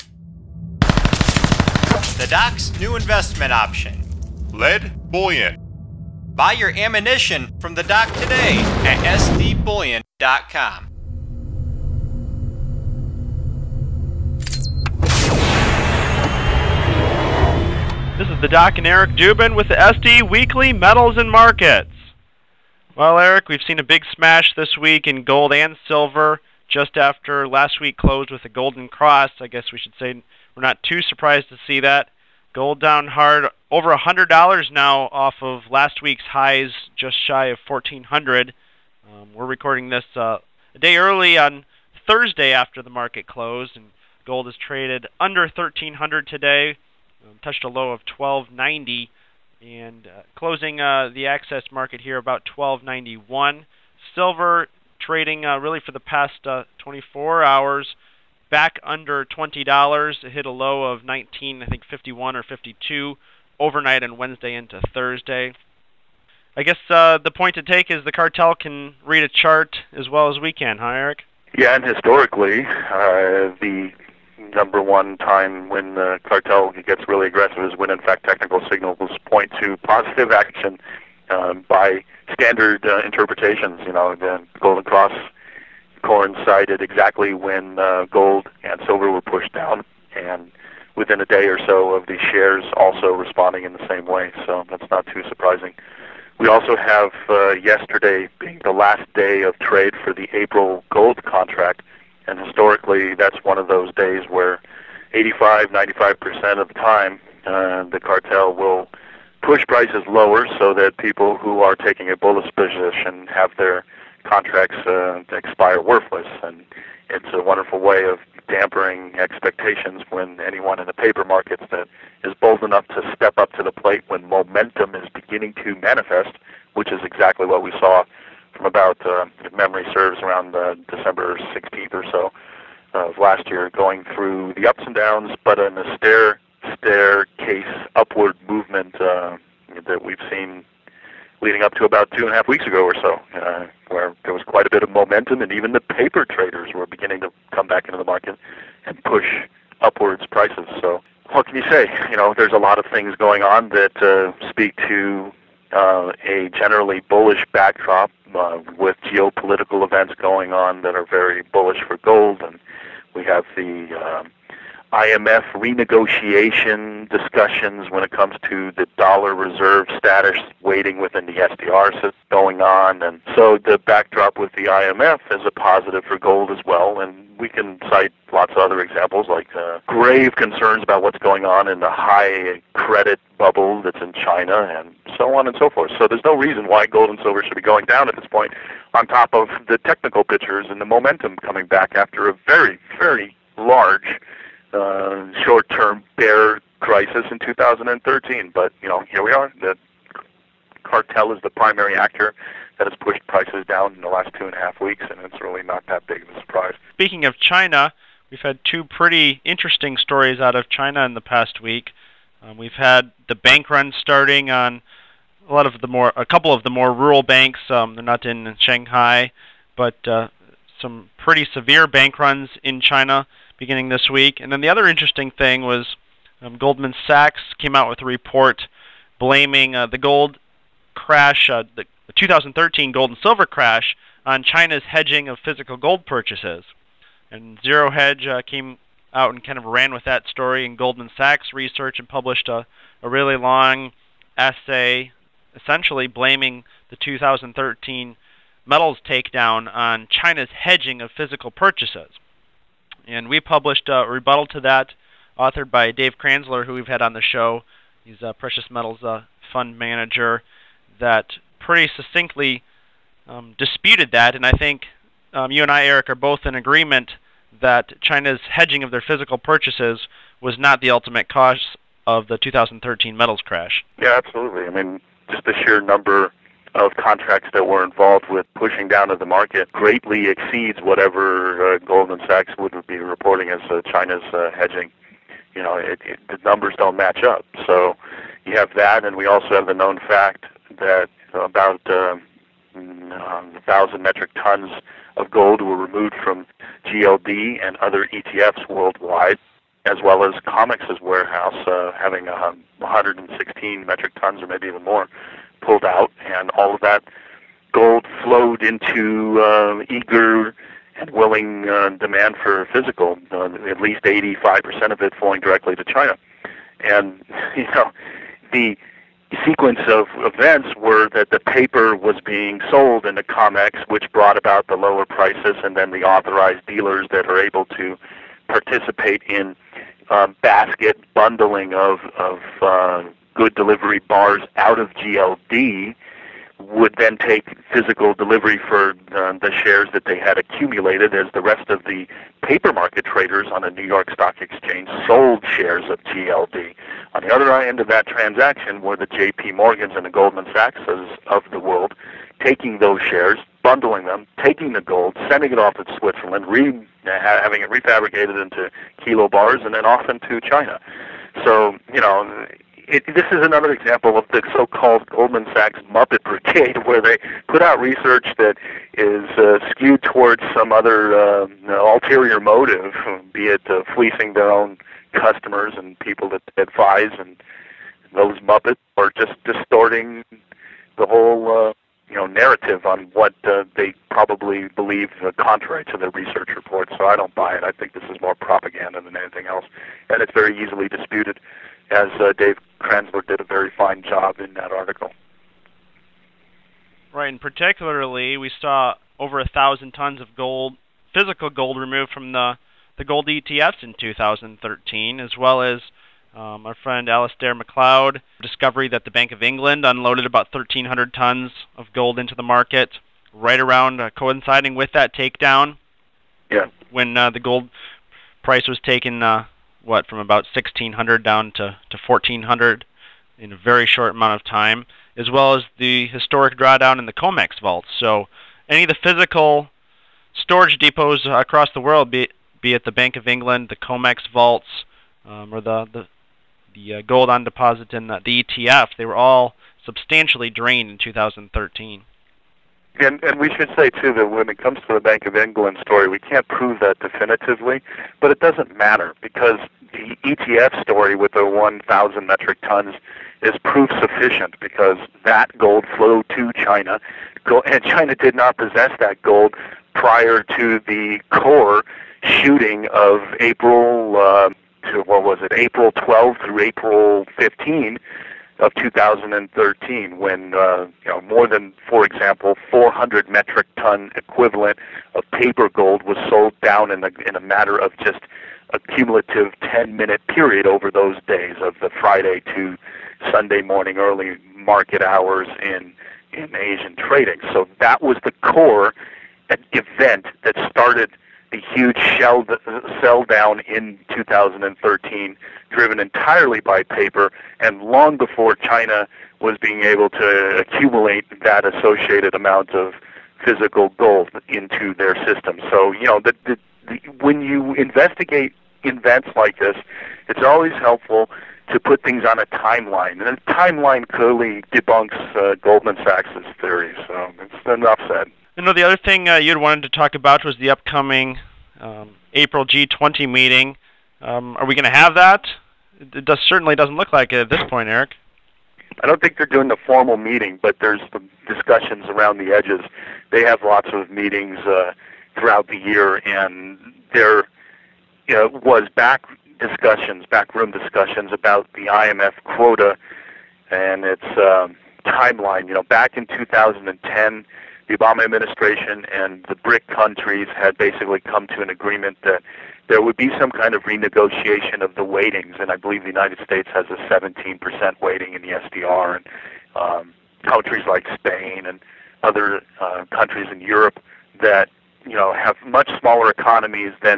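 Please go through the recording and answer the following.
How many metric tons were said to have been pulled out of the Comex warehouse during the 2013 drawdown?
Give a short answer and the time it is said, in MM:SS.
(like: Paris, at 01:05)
116, at 05:02.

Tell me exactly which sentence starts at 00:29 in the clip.
I guess we should say we're not too surprised to see that.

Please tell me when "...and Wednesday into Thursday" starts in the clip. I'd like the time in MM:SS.
01:04.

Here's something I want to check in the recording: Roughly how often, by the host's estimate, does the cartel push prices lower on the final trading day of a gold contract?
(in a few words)
85-95%.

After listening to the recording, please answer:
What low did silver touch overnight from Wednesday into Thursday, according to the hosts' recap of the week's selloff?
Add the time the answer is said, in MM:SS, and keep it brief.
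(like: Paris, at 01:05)
19.51, at 01:01.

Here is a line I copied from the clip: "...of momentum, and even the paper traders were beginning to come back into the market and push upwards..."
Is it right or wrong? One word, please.
right.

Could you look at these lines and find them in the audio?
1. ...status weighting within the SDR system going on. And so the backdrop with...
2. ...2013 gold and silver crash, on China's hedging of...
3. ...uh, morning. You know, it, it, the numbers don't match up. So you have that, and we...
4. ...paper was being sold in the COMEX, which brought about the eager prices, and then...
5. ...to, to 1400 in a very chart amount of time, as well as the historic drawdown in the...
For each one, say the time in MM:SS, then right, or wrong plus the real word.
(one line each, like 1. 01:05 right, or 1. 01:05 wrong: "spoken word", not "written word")
1. 02:49 right
2. 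03:52 right
3. 04:44 wrong: "hedging", not "morning"
4. 05:21 wrong: "lower", not "eager"
5. 07:01 wrong: "short", not "chart".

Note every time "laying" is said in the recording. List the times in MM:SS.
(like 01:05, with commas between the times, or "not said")
not said.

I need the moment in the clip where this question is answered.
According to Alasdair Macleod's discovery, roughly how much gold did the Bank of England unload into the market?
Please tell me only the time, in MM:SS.
06:50.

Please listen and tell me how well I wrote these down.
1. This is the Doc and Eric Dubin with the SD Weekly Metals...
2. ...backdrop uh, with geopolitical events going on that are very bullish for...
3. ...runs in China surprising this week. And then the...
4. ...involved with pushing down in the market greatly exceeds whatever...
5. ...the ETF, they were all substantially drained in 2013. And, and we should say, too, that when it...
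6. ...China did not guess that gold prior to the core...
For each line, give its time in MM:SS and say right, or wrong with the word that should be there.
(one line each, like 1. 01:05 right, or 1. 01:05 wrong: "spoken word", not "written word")
1. 00:18 right
2. 02:37 right
3. 03:42 wrong: "beginning", not "surprising"
4. 04:37 right
5. 07:18 right
6. 07:37 wrong: "possess", not "guess".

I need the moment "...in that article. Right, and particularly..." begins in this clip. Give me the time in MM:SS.
06:34.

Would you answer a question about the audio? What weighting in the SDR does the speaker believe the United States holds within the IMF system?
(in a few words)
17%.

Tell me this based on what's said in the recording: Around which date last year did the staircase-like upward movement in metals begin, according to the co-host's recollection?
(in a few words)
December 16th.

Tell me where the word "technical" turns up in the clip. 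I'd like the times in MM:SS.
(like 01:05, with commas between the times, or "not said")
01:18, 03:09.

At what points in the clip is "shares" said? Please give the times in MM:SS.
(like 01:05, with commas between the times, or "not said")
01:32, 05:39, 05:45, 05:53.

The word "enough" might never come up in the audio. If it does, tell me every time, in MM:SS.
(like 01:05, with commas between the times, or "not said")
02:02, 08:37.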